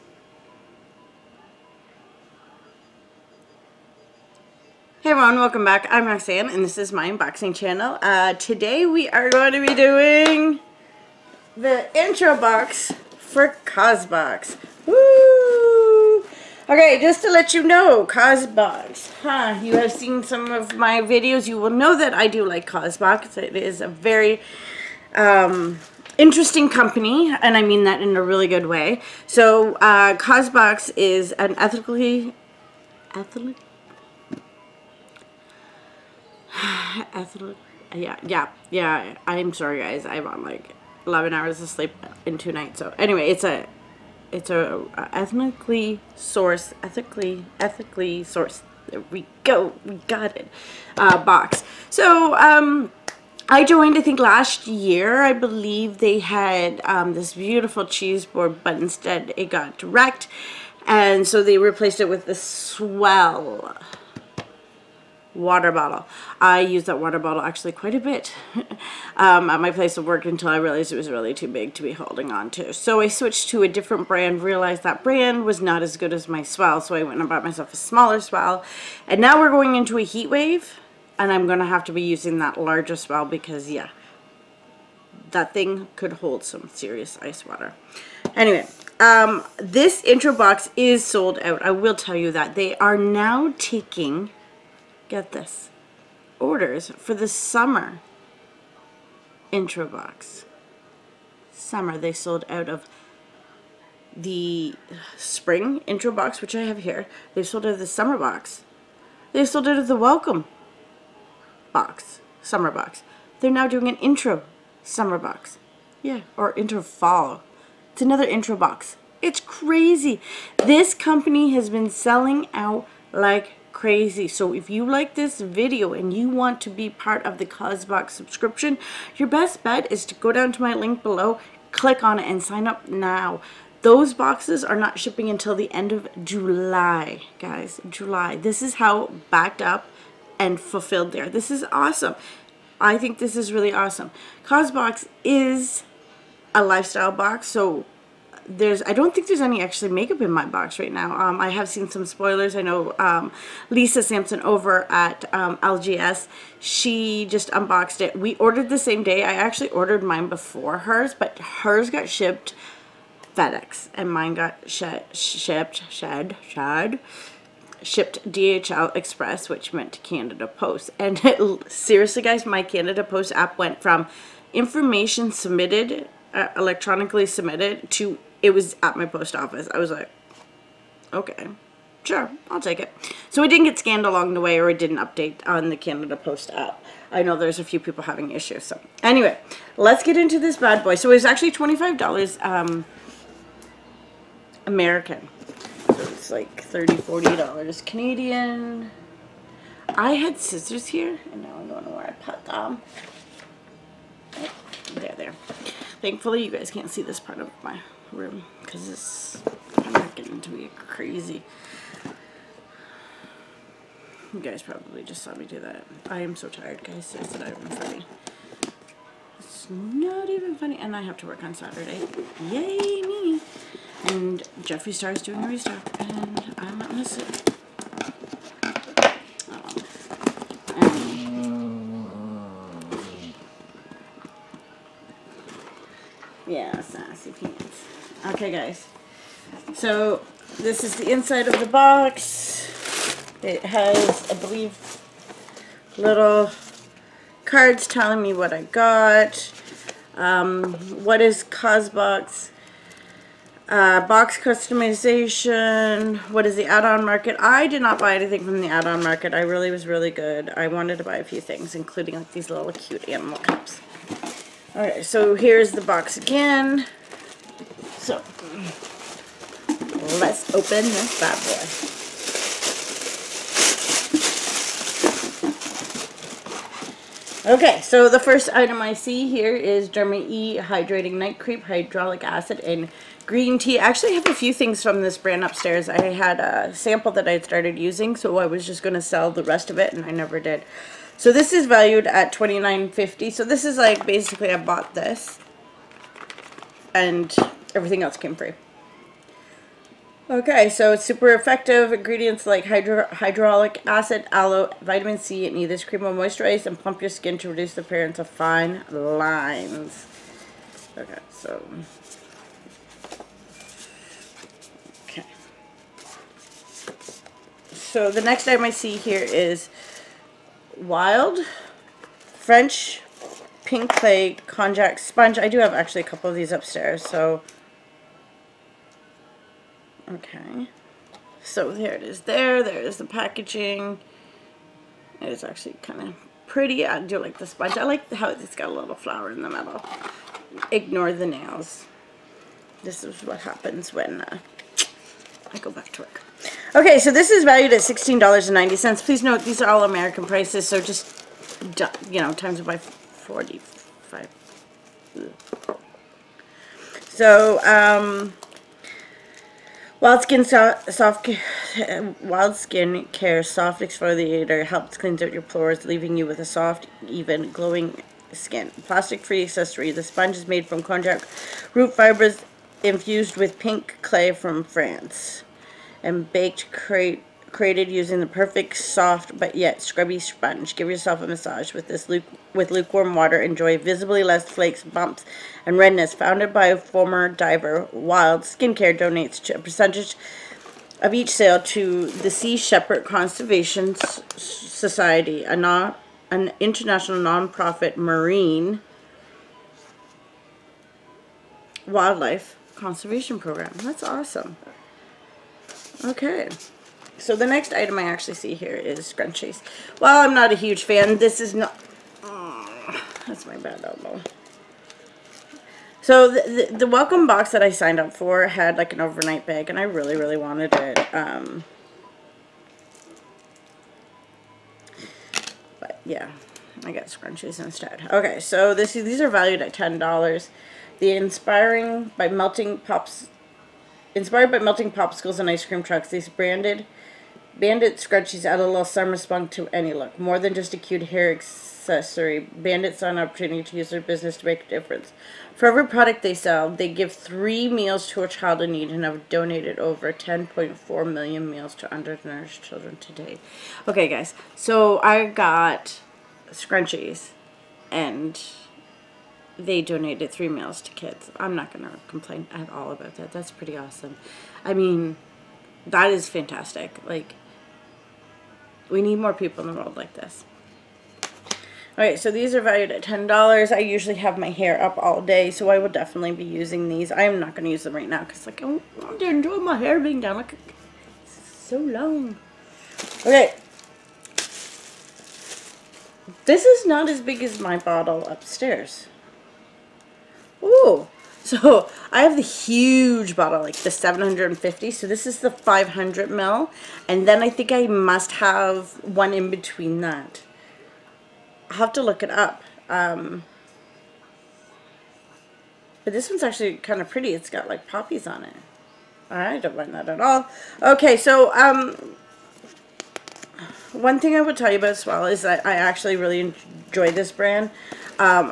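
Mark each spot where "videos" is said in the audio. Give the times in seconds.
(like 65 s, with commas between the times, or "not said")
21 s, 125 s.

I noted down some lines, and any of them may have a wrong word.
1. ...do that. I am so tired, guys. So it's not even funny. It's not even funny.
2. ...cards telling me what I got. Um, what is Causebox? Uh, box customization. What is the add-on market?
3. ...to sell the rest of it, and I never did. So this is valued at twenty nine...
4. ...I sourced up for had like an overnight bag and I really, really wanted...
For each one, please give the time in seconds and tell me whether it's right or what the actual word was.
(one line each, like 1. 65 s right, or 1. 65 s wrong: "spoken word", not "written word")
1. 215 s right
2. 247 s right
3. 288 s right
4. 417 s wrong: "signed", not "sourced".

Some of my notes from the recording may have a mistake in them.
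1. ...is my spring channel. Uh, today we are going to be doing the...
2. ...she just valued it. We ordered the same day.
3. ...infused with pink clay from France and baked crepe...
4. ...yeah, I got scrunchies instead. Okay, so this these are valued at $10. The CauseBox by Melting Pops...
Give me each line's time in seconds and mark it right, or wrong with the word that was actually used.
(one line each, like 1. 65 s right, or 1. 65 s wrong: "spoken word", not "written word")
1. 6 s wrong: "unboxing", not "spring"
2. 156 s wrong: "unboxed", not "valued"
3. 372 s right
4. 426 s wrong: "Inspiring", not "CauseBox".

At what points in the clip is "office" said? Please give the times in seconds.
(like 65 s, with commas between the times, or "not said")
179 s.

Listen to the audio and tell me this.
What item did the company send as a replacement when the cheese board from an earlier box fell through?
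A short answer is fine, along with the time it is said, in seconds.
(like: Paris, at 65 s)
swell water bottle, at 62 s.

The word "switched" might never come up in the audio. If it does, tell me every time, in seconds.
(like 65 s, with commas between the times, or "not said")
73 s.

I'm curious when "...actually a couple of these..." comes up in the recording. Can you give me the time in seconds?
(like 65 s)
325 s.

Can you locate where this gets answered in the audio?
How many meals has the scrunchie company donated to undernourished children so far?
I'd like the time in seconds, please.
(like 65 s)
450 s.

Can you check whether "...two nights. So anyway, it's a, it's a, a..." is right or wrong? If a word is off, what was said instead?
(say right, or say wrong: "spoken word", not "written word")
right.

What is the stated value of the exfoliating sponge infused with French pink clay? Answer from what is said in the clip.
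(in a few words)
$16.90.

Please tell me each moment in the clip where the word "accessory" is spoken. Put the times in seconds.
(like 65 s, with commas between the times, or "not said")
369 s, 441 s.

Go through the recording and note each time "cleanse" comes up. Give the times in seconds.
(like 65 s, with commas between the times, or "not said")
364 s.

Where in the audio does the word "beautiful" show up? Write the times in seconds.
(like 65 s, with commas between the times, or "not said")
57 s.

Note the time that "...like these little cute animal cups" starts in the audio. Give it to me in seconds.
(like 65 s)
262 s.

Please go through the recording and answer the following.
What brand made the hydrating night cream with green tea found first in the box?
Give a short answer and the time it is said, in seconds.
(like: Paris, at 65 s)
Derma E, at 279 s.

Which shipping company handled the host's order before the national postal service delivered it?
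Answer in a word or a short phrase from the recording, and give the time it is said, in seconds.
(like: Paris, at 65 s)
DHL Express, at 168 s.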